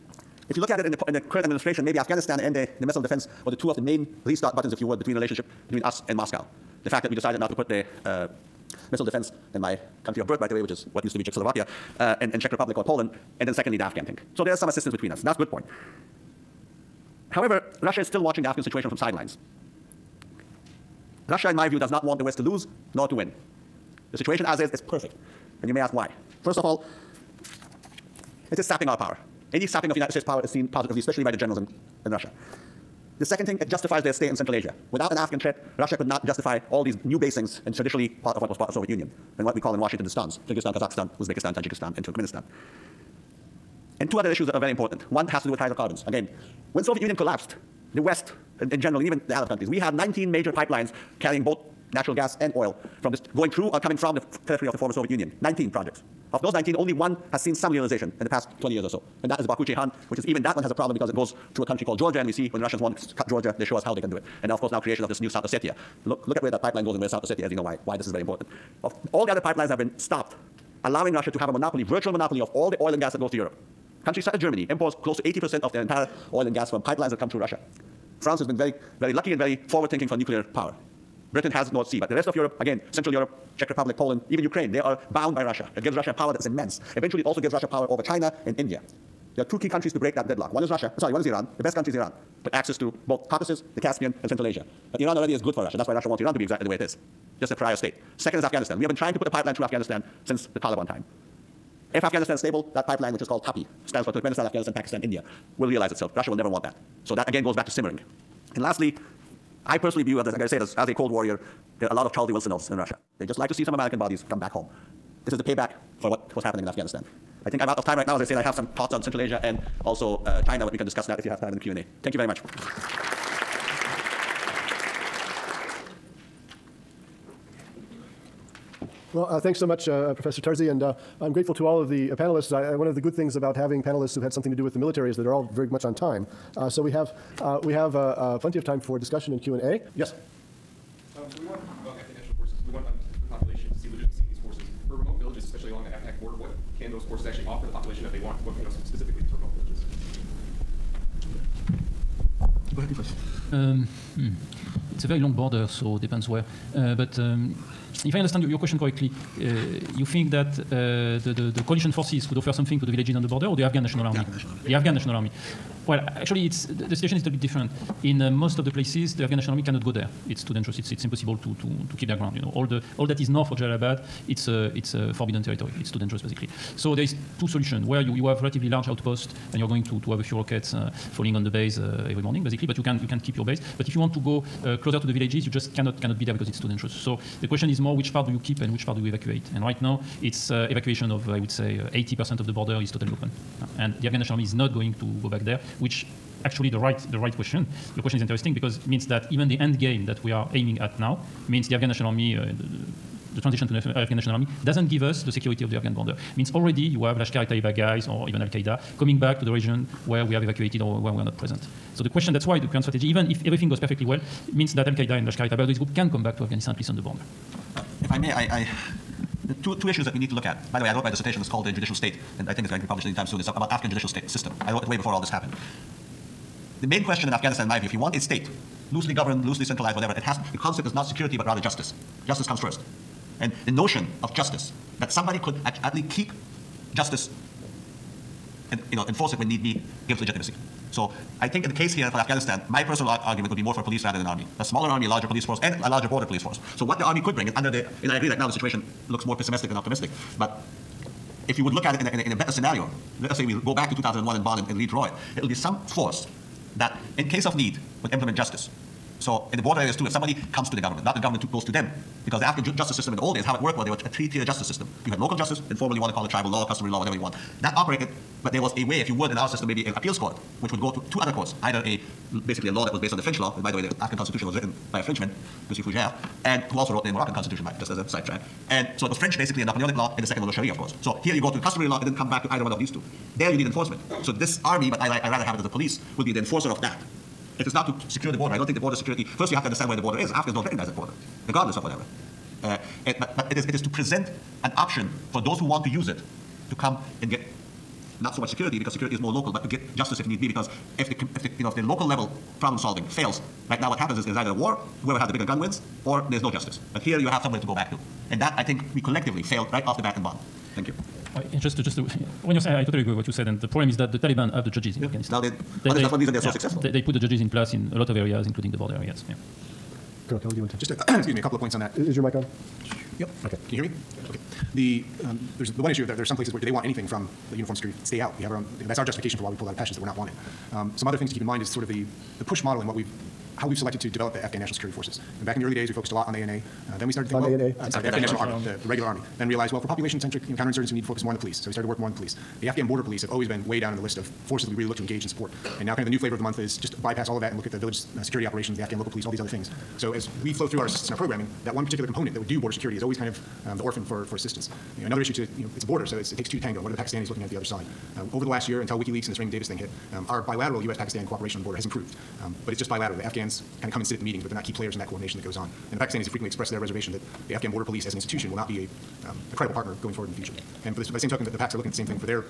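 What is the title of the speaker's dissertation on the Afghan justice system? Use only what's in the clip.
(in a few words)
The Judicial State.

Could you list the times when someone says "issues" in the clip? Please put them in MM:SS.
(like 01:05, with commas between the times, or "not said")
00:44, 03:39, 05:25, 05:55.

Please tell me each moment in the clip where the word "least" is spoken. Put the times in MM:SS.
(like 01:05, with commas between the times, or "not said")
03:36, 03:55.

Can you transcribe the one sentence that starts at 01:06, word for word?
Look, look at where that pipeline goes and where South Ossetia, is.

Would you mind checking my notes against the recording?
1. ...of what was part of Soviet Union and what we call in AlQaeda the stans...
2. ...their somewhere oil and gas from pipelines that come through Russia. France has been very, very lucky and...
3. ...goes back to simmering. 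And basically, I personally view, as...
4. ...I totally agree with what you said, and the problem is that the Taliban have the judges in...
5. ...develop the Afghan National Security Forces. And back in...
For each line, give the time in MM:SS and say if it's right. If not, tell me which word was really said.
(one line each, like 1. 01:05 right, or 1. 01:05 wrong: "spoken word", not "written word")
1. 00:38 wrong: "Washington", not "AlQaeda"
2. 01:15 wrong: "entire", not "somewhere"
3. 01:47 wrong: "lastly", not "basically"
4. 05:12 right
5. 05:34 right.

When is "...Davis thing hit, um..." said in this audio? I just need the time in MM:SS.
05:59.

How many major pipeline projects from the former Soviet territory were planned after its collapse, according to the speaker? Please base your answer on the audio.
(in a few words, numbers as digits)
19.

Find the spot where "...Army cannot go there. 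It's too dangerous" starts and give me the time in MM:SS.
02:49.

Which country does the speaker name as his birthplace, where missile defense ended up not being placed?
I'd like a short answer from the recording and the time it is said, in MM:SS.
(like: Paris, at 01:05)
Czechoslovakia, at 00:11.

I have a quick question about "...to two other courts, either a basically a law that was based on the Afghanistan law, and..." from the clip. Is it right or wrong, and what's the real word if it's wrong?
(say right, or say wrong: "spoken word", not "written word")
wrong: "French", not "Afghanistan".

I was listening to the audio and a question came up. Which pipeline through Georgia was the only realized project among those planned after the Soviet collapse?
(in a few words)
Baku Ceyhan.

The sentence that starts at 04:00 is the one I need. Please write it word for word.
So I think in the case here for Afghanistan, my personal ar argument would be more for police rather than army.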